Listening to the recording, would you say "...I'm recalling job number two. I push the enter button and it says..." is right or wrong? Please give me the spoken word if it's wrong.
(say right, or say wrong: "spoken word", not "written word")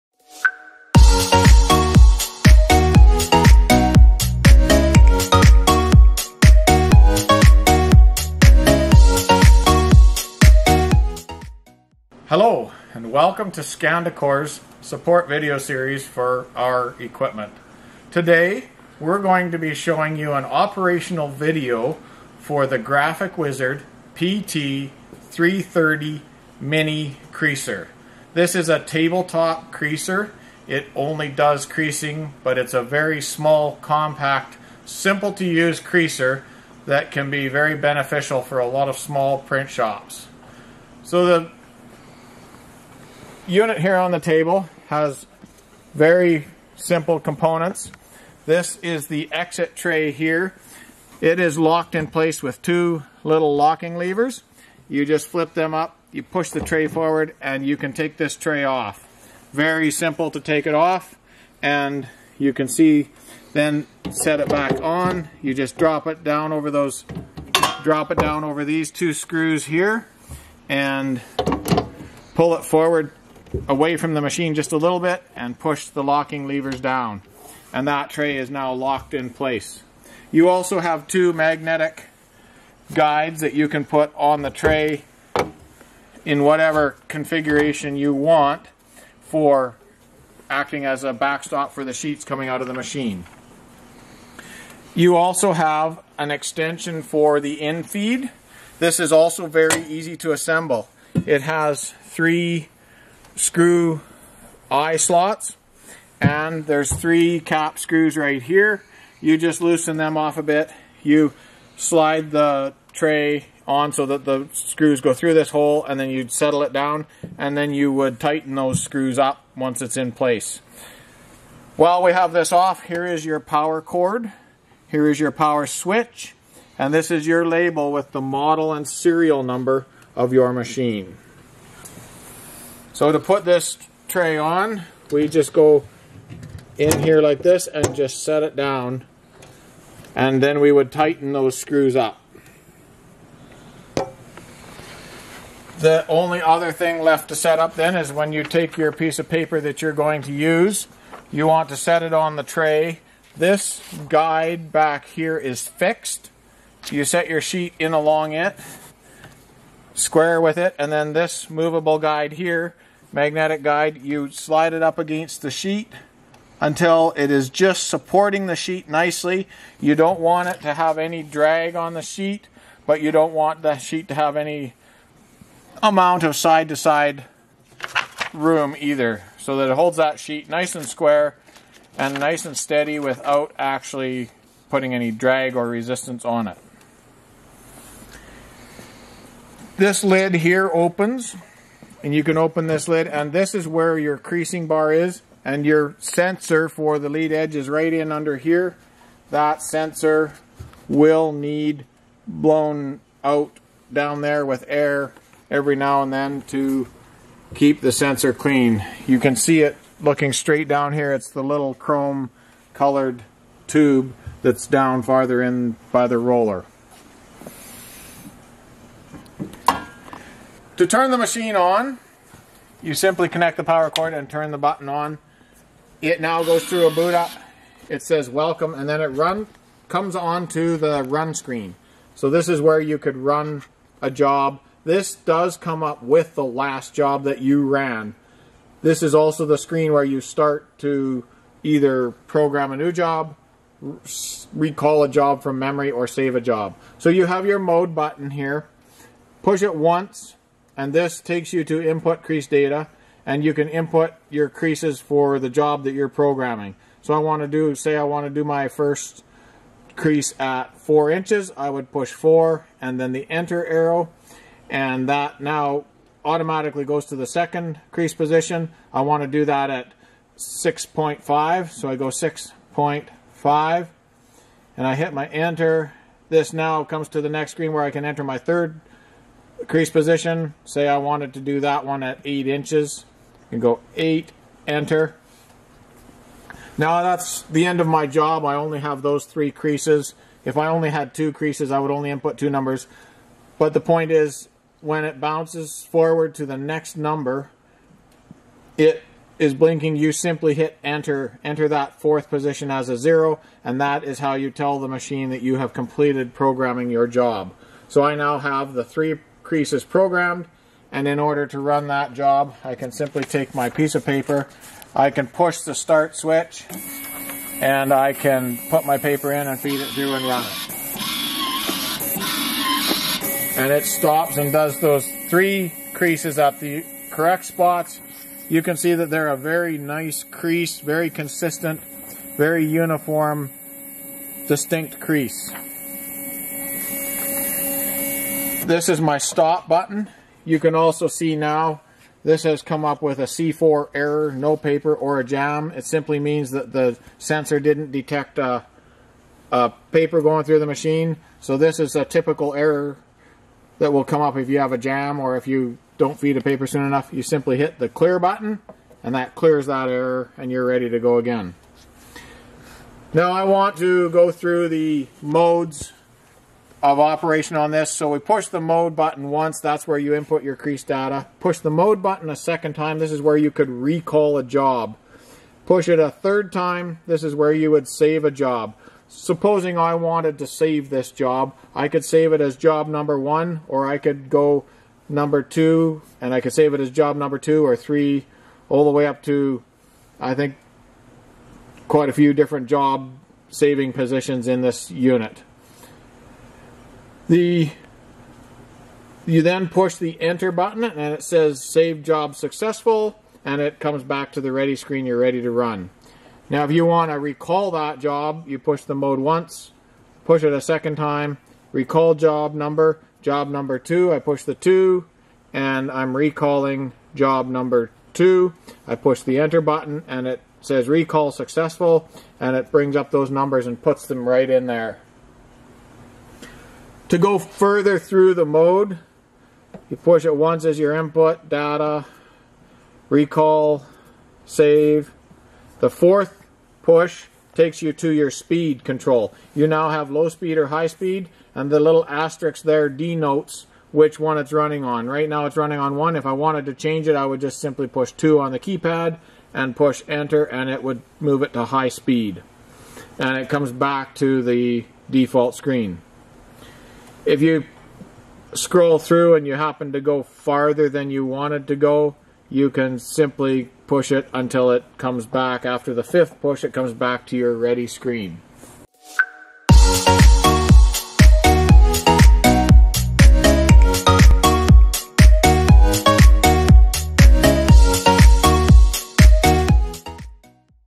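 right.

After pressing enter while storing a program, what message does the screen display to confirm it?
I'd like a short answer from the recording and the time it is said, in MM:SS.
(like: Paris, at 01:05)
Save job successful, at 06:41.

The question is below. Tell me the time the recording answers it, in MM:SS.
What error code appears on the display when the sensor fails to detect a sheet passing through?
05:43.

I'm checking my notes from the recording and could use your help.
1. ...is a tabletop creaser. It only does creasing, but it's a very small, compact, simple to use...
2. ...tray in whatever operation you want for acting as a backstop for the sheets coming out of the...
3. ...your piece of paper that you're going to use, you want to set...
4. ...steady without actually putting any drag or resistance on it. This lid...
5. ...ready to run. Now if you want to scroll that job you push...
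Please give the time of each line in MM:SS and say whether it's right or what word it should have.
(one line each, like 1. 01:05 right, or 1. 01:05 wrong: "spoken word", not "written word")
1. 00:28 right
2. 01:24 wrong: "configuration", not "operation"
3. 02:28 right
4. 03:02 right
5. 06:45 wrong: "recall", not "scroll".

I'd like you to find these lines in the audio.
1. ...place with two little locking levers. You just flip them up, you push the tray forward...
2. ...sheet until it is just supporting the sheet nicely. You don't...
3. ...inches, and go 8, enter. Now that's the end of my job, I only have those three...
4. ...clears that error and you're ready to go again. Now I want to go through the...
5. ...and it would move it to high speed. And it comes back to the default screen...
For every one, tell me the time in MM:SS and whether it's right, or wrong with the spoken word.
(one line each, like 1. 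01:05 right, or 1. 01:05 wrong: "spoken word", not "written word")
1. 00:52 right
2. 02:45 right
3. 04:42 right
4. 05:59 right
5. 07:30 right.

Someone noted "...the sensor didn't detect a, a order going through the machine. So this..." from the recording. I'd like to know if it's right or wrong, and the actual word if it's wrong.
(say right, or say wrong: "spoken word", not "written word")
wrong: "paper", not "order".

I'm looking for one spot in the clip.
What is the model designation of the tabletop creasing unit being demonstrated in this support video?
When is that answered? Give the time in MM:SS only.
00:24.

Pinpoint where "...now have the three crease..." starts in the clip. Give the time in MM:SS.
05:08.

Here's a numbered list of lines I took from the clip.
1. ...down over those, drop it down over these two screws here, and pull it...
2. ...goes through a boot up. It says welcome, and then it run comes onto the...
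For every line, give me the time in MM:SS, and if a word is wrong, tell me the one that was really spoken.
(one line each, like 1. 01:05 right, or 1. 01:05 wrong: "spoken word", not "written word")
1. 01:06 right
2. 03:46 right.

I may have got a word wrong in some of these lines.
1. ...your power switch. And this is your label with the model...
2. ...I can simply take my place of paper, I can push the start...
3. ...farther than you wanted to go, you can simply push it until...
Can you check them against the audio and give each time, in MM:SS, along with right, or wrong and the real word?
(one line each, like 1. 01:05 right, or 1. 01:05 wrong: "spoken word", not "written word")
1. 02:05 right
2. 05:12 wrong: "piece", not "place"
3. 07:40 right.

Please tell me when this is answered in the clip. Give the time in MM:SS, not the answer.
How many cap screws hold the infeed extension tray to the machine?
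01:46.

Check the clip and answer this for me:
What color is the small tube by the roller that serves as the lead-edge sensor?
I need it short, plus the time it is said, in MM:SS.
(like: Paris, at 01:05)
Chrome, at 03:31.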